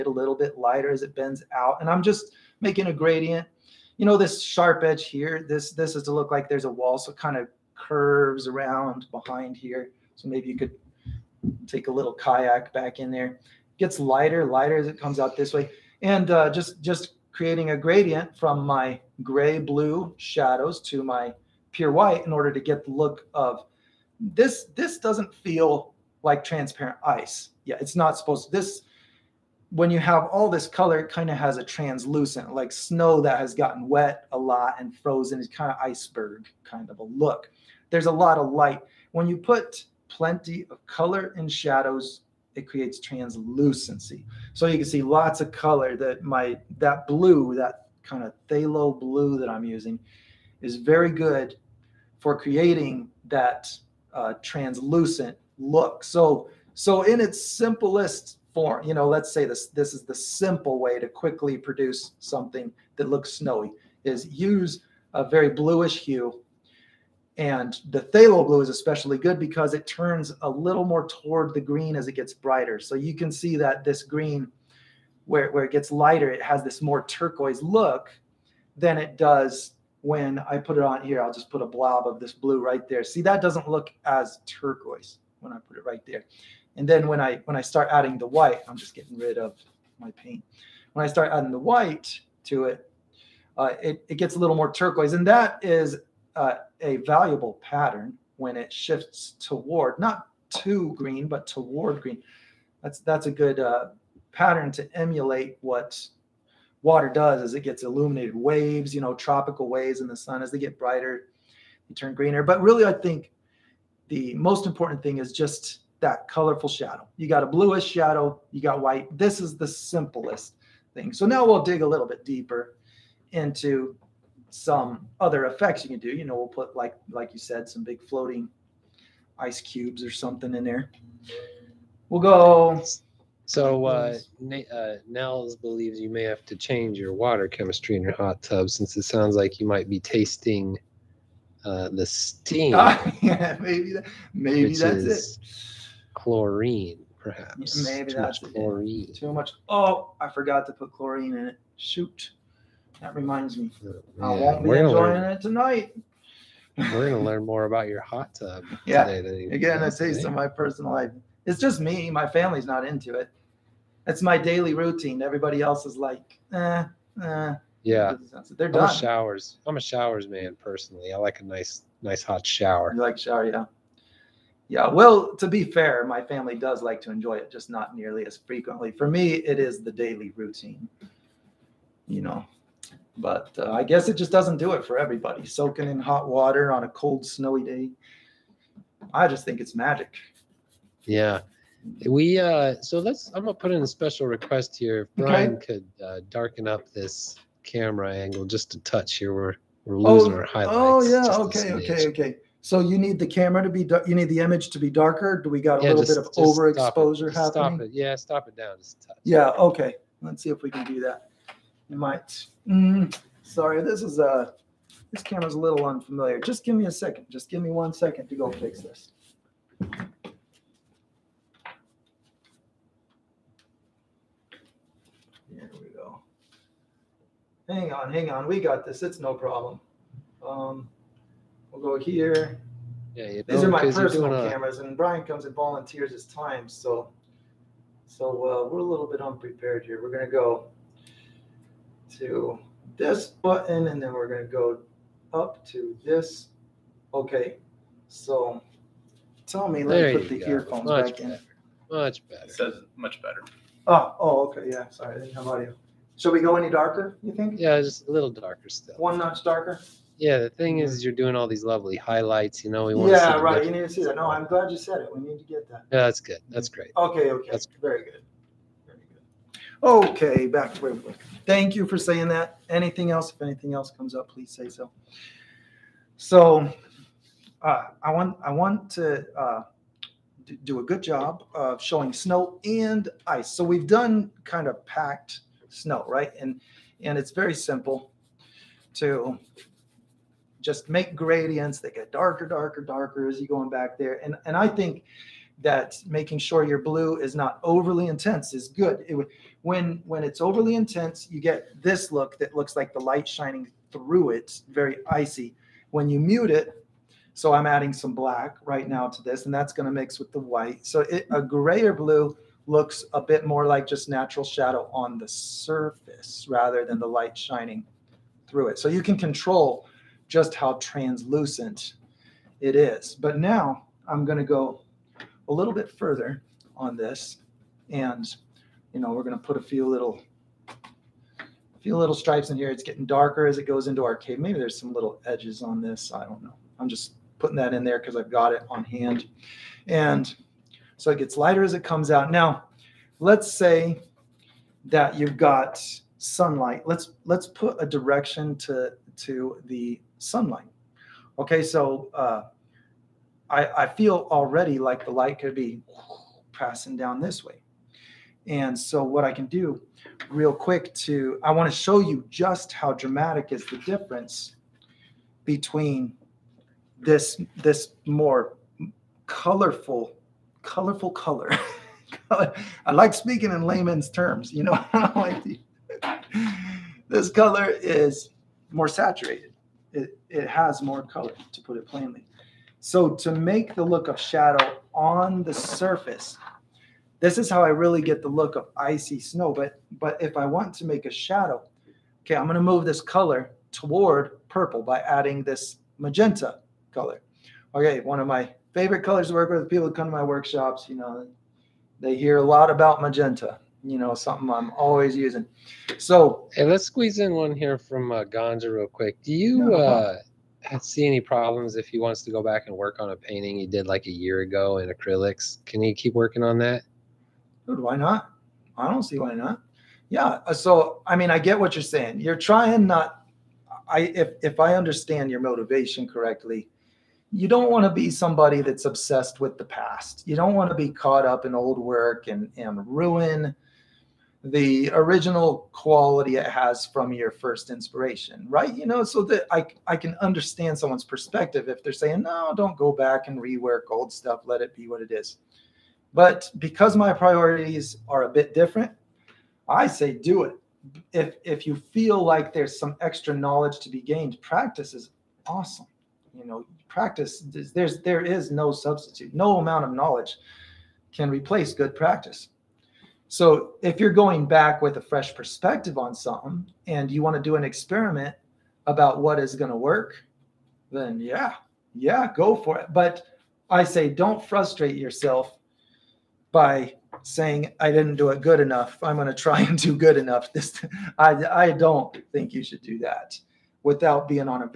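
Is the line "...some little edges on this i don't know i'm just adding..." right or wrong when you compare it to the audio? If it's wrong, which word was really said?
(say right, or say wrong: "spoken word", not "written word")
wrong: "putting", not "adding".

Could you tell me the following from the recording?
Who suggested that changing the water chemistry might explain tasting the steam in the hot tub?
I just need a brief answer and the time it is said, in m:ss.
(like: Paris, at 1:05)
Nels, at 2:15.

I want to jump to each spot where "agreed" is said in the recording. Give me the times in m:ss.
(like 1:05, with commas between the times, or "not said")
not said.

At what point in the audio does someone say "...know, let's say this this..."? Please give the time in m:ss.
0:58.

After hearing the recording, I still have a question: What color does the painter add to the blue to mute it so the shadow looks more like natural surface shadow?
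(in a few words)
Black.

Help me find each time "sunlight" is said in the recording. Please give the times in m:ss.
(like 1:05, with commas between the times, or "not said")
5:46, 5:50.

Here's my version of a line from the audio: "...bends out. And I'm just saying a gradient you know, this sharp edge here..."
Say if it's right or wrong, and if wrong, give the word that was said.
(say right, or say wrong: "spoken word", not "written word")
wrong: "making", not "saying".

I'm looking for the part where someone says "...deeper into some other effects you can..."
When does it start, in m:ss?
2:02.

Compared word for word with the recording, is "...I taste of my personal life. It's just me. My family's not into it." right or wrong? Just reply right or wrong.
right.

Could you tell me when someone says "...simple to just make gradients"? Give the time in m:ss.
4:47.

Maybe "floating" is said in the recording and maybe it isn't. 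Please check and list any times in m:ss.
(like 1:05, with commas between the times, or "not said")
2:08.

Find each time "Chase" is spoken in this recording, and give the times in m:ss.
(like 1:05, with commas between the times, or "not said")
not said.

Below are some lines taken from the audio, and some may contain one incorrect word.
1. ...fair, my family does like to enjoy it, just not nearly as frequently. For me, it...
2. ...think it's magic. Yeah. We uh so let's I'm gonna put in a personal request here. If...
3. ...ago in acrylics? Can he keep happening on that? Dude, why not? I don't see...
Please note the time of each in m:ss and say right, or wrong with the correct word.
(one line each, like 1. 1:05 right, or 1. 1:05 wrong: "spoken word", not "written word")
1. 2:55 right
2. 3:09 wrong: "special", not "personal"
3. 6:54 wrong: "working", not "happening".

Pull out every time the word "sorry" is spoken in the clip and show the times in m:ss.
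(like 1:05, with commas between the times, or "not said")
3:33, 4:14.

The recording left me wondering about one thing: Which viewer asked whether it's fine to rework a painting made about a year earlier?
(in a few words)
Ganja.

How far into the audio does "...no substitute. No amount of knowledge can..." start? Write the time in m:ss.
7:38.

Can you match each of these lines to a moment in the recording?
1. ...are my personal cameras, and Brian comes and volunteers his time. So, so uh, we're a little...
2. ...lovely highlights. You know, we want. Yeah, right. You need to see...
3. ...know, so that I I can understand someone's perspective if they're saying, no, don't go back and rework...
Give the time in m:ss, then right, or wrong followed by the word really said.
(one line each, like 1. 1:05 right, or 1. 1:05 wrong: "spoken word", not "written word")
1. 3:53 right
2. 4:21 right
3. 7:18 right.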